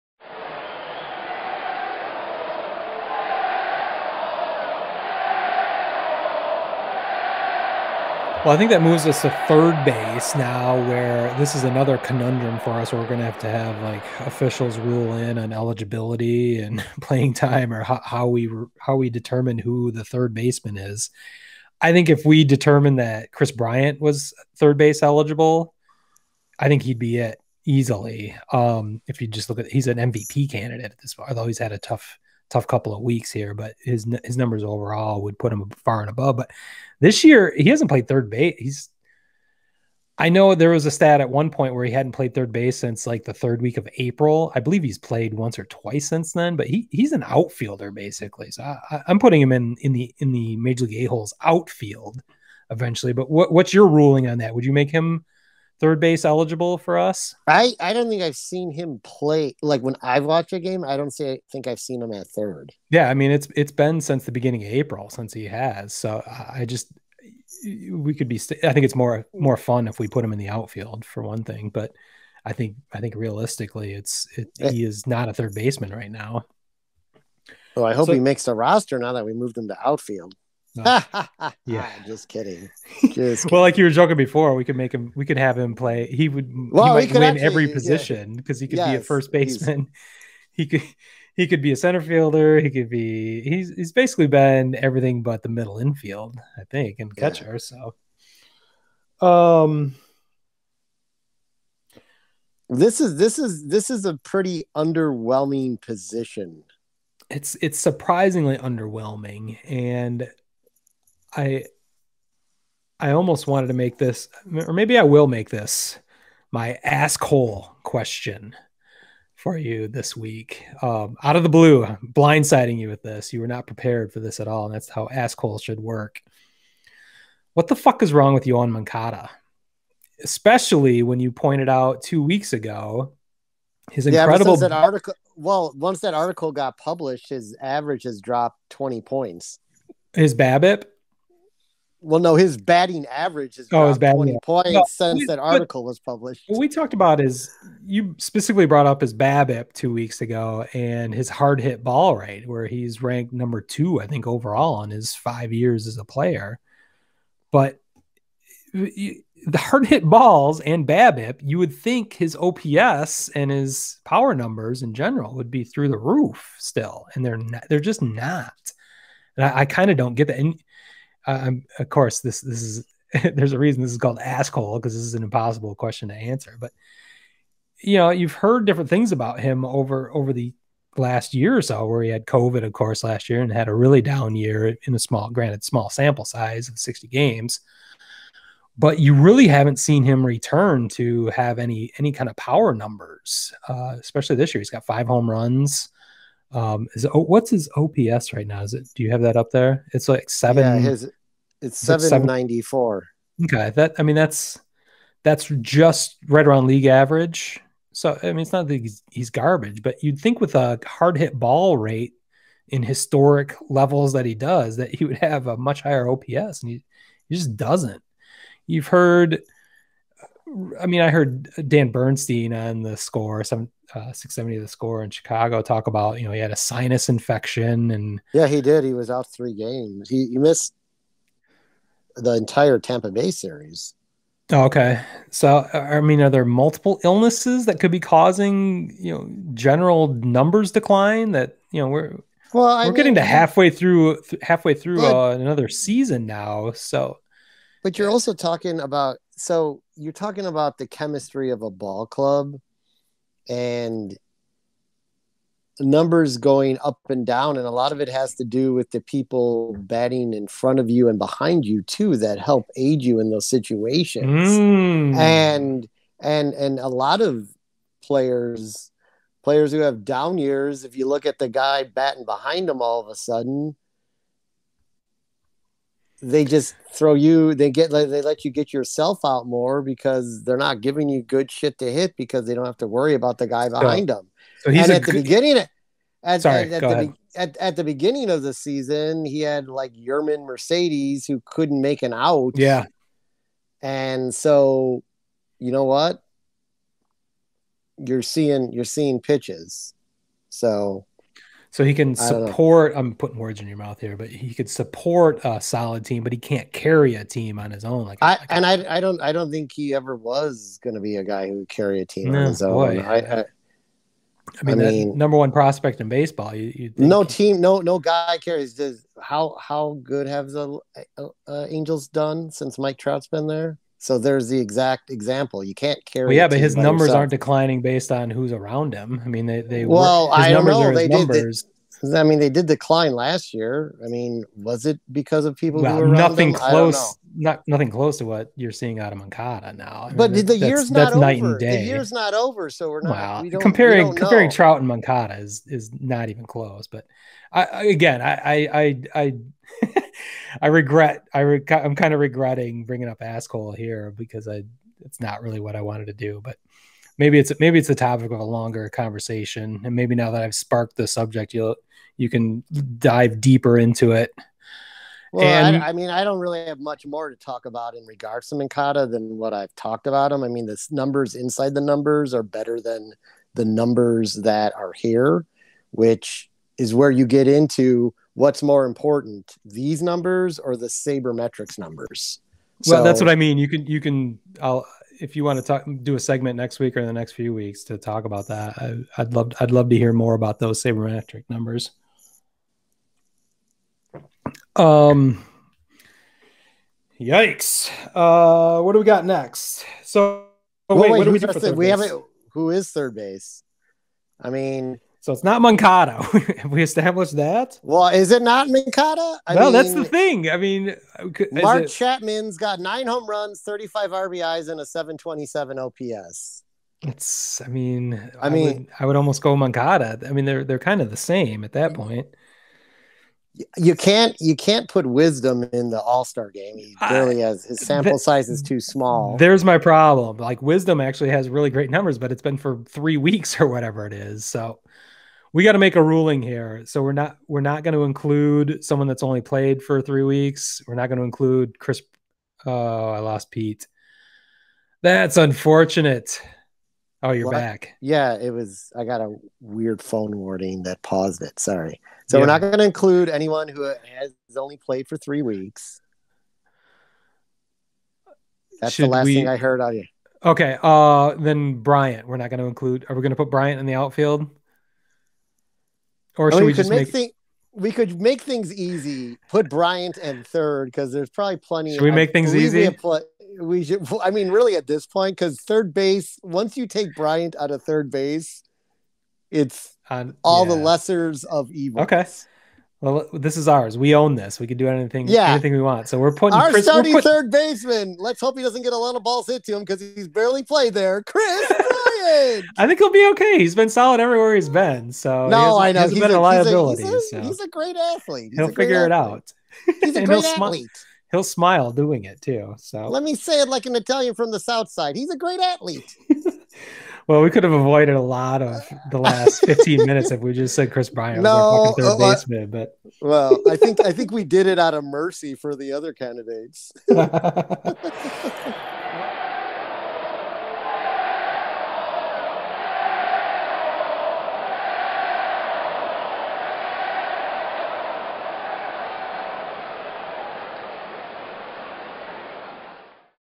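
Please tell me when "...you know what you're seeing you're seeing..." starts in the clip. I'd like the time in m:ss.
4:55.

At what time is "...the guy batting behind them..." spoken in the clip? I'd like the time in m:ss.
4:31.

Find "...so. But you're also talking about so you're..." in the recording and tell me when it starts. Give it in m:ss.
4:06.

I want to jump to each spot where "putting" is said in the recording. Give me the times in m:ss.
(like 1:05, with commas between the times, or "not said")
0:49, 5:03, 8:06.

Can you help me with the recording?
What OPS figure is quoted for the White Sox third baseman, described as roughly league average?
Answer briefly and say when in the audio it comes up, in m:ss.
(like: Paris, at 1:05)
.794, at 3:21.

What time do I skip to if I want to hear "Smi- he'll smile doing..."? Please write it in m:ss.
8:20.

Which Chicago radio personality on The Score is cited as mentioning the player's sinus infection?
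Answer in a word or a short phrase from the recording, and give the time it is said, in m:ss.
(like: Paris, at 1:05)
Dan Bernstein, at 3:41.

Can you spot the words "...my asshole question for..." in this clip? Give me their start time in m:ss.
1:56.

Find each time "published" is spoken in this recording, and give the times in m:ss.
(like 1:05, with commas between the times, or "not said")
2:16, 2:25.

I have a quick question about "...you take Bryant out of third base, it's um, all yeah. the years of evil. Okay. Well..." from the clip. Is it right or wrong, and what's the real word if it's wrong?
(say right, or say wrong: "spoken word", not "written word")
wrong: "lessers", not "years".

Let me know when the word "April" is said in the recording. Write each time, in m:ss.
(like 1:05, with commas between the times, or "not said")
0:43, 1:04.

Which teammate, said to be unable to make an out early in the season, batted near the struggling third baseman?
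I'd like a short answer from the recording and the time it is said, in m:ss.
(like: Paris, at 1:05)
Yermín Mercedes, at 4:49.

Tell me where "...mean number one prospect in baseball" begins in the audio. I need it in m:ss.
5:14.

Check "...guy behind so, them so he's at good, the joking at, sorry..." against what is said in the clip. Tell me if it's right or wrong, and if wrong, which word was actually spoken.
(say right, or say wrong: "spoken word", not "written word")
wrong: "beginning", not "joking".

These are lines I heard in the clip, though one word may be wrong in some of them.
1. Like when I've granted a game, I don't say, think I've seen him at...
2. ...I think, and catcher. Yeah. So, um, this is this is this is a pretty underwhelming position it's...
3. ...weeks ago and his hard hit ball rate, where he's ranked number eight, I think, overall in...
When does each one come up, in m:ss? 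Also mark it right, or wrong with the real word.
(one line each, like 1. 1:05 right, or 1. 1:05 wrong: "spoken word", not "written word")
1. 0:59 wrong: "watched", not "granted"
2. 1:36 right
3. 2:29 wrong: "two", not "eight".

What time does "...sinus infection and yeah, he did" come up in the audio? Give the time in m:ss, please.
3:46.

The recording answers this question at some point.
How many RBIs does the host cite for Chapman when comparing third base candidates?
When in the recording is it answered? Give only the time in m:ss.
6:53.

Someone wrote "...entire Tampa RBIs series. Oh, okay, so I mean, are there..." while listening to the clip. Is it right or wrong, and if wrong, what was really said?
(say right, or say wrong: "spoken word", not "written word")
wrong: "Bay", not "RBIs".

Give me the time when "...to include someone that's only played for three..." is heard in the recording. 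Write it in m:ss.
7:17.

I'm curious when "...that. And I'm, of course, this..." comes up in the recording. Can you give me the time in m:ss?
2:50.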